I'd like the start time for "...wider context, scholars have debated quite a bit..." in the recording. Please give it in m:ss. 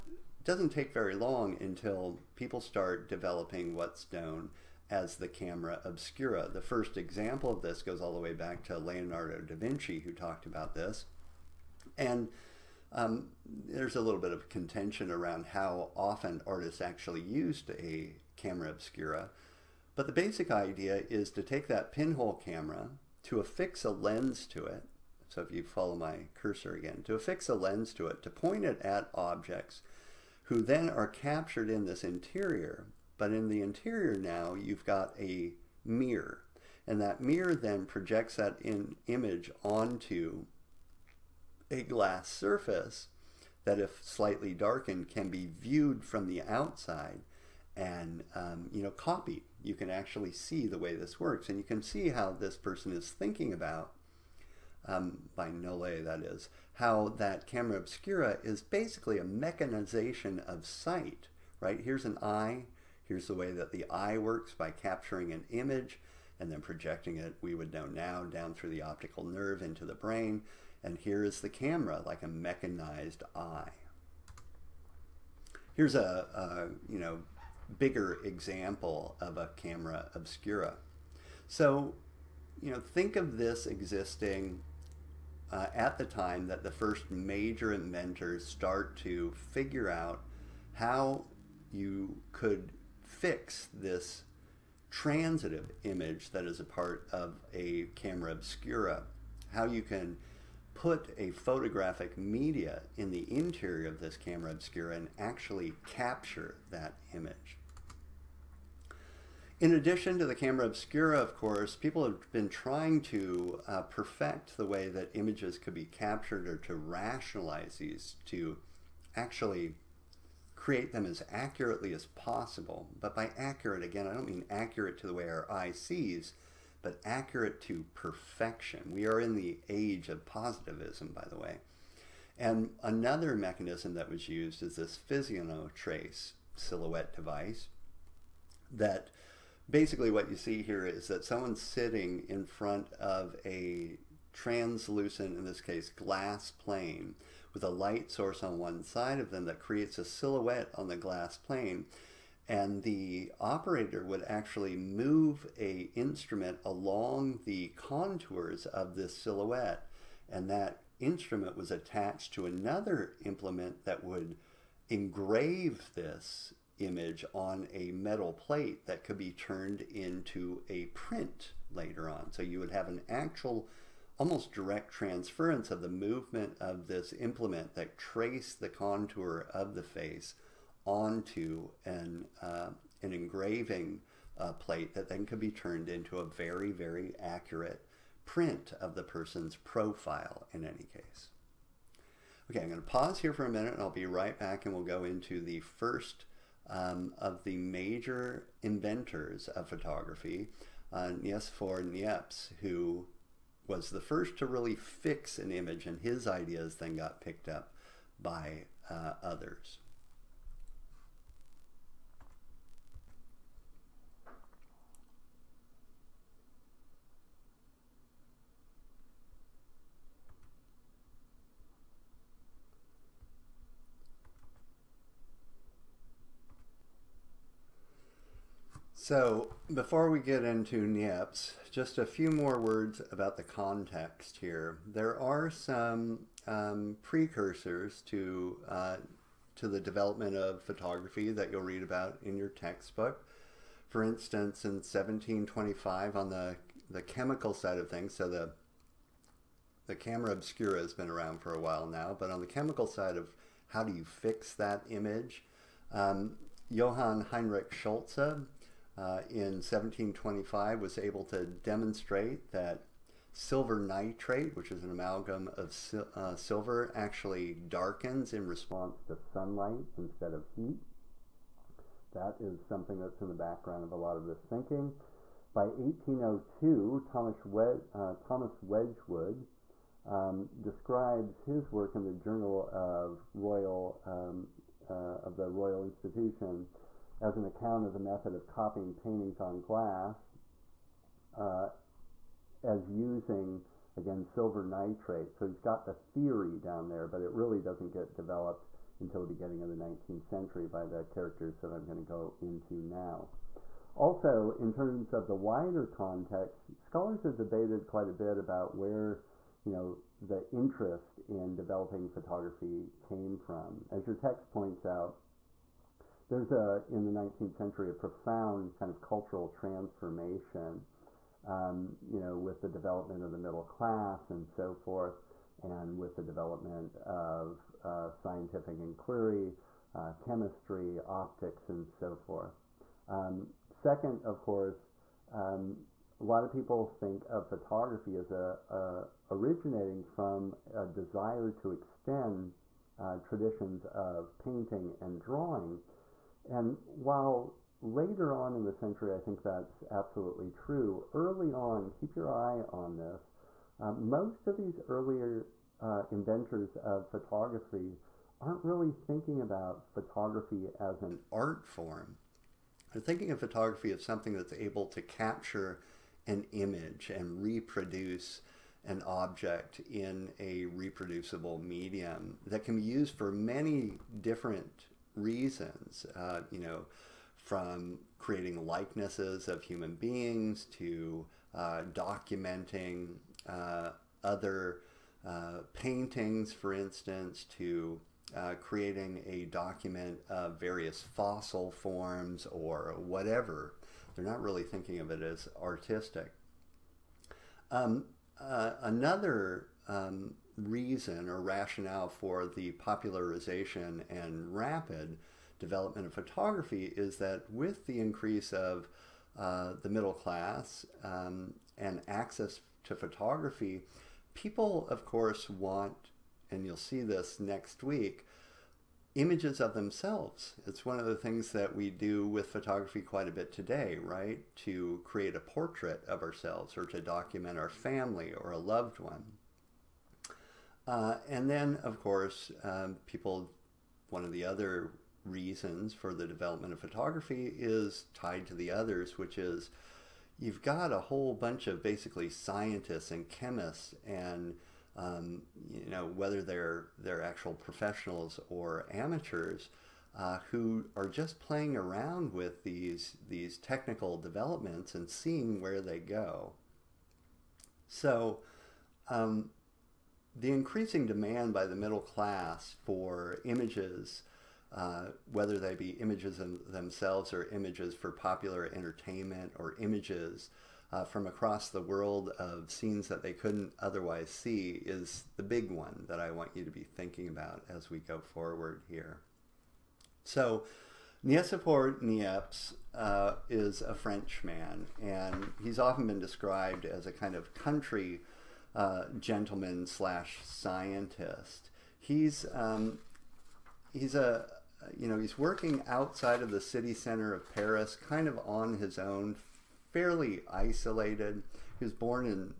5:05.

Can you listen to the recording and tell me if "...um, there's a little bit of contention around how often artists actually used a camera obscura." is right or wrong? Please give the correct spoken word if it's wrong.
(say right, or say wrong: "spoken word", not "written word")
right.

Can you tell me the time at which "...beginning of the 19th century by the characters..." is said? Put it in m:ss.
4:59.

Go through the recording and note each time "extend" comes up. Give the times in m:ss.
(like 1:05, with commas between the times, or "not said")
5:41.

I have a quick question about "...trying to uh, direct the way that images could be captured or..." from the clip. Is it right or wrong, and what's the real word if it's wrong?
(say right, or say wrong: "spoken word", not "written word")
wrong: "perfect", not "direct".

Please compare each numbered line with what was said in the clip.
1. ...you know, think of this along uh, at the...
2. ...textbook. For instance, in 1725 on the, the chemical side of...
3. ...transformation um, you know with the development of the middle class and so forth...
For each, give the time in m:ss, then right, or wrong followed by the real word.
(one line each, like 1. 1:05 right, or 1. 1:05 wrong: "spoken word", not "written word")
1. 1:22 wrong: "existing", not "along"
2. 4:02 right
3. 5:19 right.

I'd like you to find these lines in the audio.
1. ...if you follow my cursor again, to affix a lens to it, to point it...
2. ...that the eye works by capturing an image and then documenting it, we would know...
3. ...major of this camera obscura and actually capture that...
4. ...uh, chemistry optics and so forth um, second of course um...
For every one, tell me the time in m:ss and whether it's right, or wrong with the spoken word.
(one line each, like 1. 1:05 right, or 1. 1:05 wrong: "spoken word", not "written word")
1. 0:25 right
2. 1:03 wrong: "projecting", not "documenting"
3. 1:43 wrong: "interior", not "major"
4. 5:29 right.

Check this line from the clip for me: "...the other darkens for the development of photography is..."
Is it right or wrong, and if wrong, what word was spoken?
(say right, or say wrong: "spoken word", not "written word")
wrong: "reasons", not "darkens".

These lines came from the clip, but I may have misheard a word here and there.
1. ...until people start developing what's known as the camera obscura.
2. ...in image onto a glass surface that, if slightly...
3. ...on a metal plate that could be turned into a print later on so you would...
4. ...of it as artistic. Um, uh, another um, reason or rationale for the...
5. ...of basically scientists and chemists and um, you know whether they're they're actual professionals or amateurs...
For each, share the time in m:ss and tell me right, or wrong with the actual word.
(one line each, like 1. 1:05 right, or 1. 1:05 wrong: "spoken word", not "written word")
1. 0:01 right
2. 0:38 right
3. 2:47 right
4. 6:35 right
5. 7:21 right.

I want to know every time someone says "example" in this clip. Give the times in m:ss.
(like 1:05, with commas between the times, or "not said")
0:06, 1:18.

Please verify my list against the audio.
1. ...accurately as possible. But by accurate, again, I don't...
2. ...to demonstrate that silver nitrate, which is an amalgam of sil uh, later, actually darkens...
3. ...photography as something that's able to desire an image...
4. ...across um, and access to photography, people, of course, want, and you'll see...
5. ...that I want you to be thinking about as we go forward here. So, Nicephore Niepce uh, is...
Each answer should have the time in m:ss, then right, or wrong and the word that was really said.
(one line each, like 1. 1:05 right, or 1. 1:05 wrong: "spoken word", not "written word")
1. 2:01 right
2. 4:21 wrong: "silver", not "later"
3. 6:03 wrong: "capture", not "desire"
4. 6:50 wrong: "class", not "across"
5. 7:56 right.